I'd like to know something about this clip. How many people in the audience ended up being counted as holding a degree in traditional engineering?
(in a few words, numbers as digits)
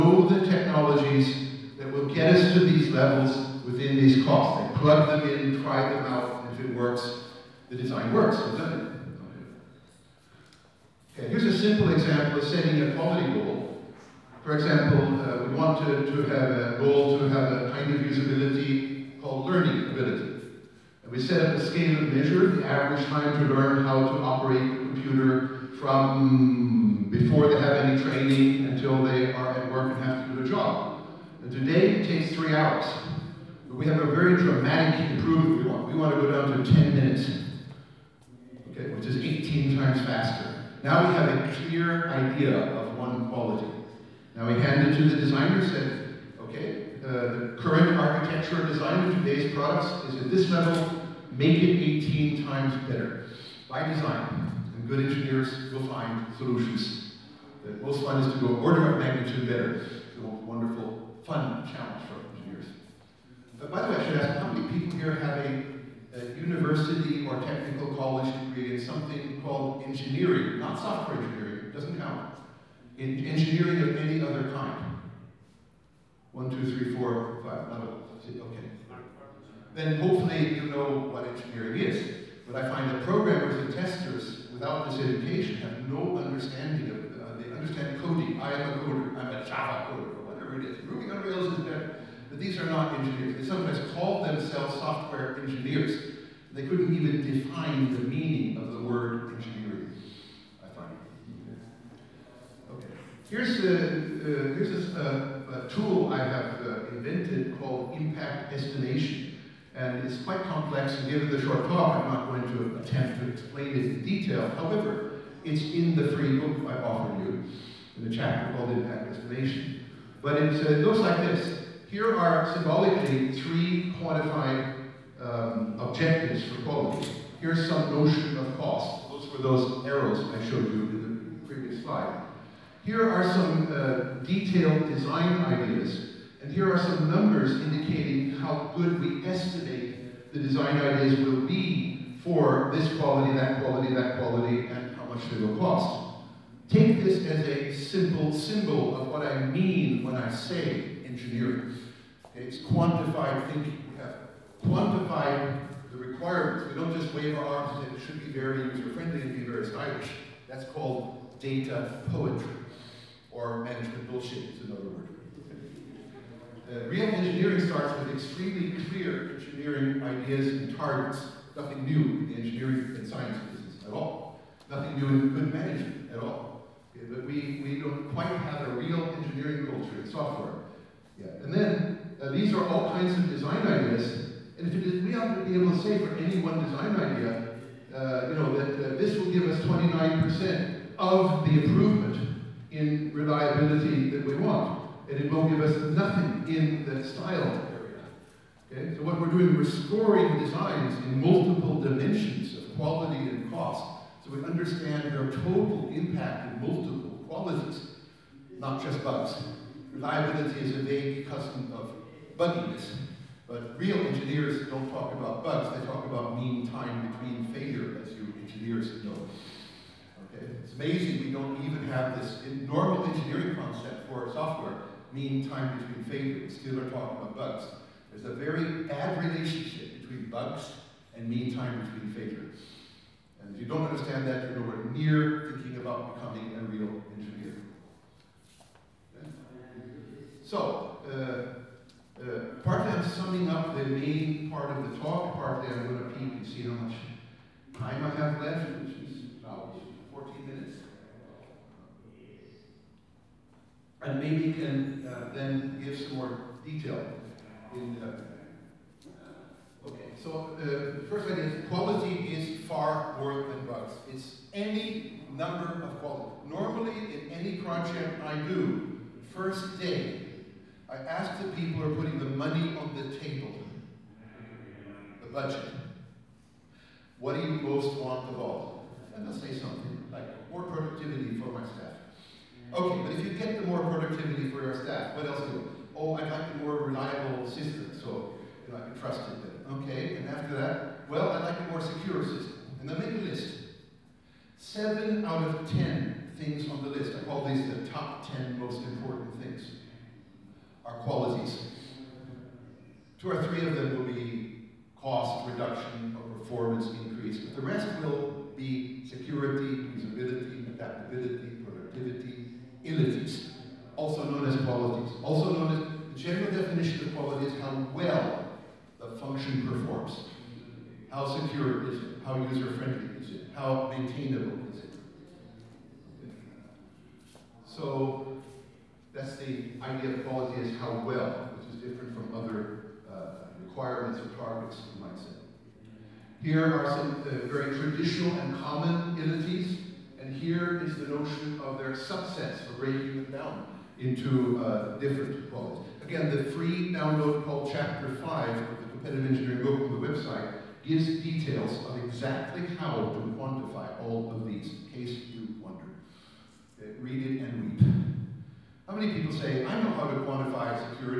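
11.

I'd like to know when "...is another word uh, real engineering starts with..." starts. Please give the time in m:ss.
2:44.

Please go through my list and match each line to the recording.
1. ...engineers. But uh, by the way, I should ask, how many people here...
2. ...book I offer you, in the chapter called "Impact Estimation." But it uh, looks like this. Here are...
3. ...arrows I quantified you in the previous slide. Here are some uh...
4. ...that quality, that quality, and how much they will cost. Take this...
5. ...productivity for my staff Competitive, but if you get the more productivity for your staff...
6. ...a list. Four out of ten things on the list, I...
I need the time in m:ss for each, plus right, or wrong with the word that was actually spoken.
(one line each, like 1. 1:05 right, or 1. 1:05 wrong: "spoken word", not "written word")
1. 1:02 right
2. 1:56 right
3. 2:09 wrong: "showed", not "quantified"
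4. 2:23 right
5. 4:40 wrong: "Okay", not "Competitive"
6. 4:53 wrong: "Seven", not "Four".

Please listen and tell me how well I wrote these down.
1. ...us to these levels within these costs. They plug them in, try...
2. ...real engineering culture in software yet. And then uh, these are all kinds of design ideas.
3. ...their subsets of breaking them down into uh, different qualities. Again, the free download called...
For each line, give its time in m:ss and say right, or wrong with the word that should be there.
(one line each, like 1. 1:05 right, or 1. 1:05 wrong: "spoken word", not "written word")
1. 0:02 right
2. 2:58 right
3. 5:41 right.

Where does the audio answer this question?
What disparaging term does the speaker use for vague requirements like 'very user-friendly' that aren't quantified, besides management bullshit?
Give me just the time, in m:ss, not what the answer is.
2:41.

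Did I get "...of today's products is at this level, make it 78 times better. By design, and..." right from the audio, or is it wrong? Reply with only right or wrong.
wrong.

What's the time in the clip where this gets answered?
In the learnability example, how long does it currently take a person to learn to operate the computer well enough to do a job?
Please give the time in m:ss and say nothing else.
0:32.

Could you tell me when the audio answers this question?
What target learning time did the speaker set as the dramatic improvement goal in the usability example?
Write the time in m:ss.
0:36.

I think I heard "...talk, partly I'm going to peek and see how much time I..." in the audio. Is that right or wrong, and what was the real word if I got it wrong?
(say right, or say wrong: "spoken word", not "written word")
right.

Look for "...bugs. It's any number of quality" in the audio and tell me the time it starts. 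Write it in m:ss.
4:23.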